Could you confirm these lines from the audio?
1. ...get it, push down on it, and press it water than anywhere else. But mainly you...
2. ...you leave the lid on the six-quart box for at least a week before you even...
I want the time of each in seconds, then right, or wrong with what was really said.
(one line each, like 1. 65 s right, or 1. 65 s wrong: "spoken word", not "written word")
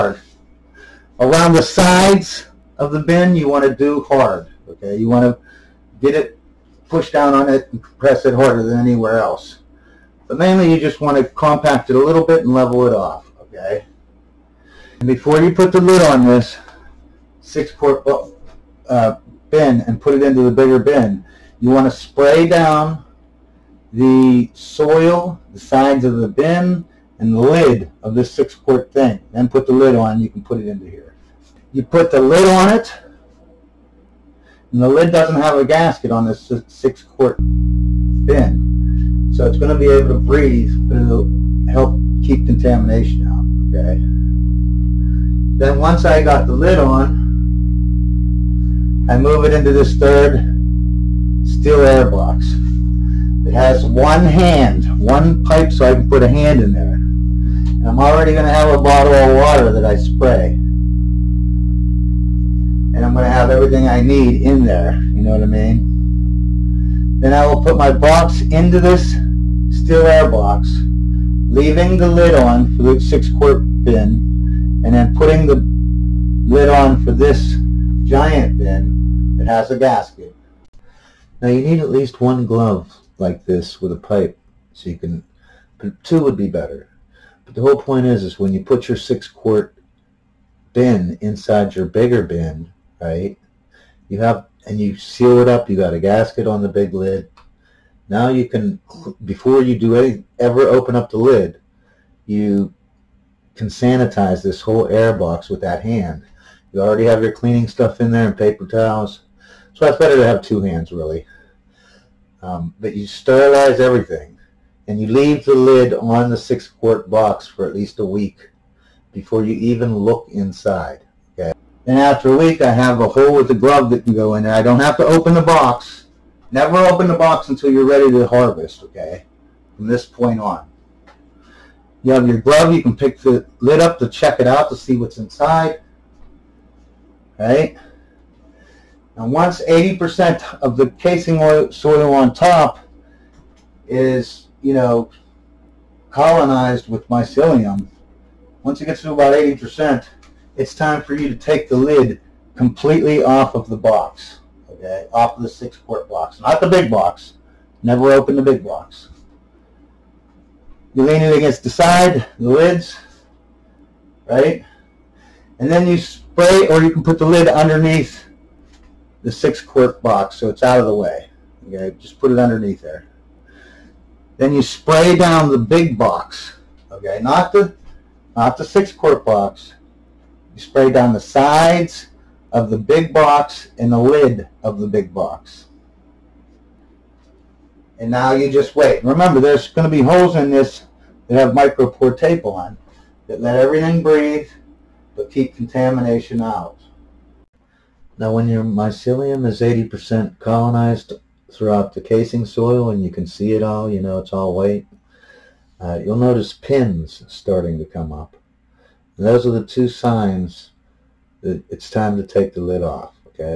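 1. 5 s wrong: "harder", not "water"
2. 114 s right.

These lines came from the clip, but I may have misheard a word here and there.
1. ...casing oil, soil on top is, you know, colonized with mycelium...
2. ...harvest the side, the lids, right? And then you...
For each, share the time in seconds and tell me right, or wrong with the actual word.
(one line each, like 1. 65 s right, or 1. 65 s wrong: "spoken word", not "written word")
1. 140 s right
2. 161 s wrong: "against", not "harvest".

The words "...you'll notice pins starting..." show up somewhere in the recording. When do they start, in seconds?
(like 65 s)
206 s.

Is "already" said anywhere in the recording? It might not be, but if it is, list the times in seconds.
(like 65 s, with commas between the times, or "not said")
57 s, 106 s.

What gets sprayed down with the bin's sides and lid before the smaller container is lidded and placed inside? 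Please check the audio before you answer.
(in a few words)
the soil.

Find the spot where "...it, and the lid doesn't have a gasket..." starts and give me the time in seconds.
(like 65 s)
32 s.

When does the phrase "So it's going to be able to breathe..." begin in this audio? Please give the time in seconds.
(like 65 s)
39 s.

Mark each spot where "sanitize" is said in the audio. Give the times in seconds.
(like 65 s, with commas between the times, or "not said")
103 s.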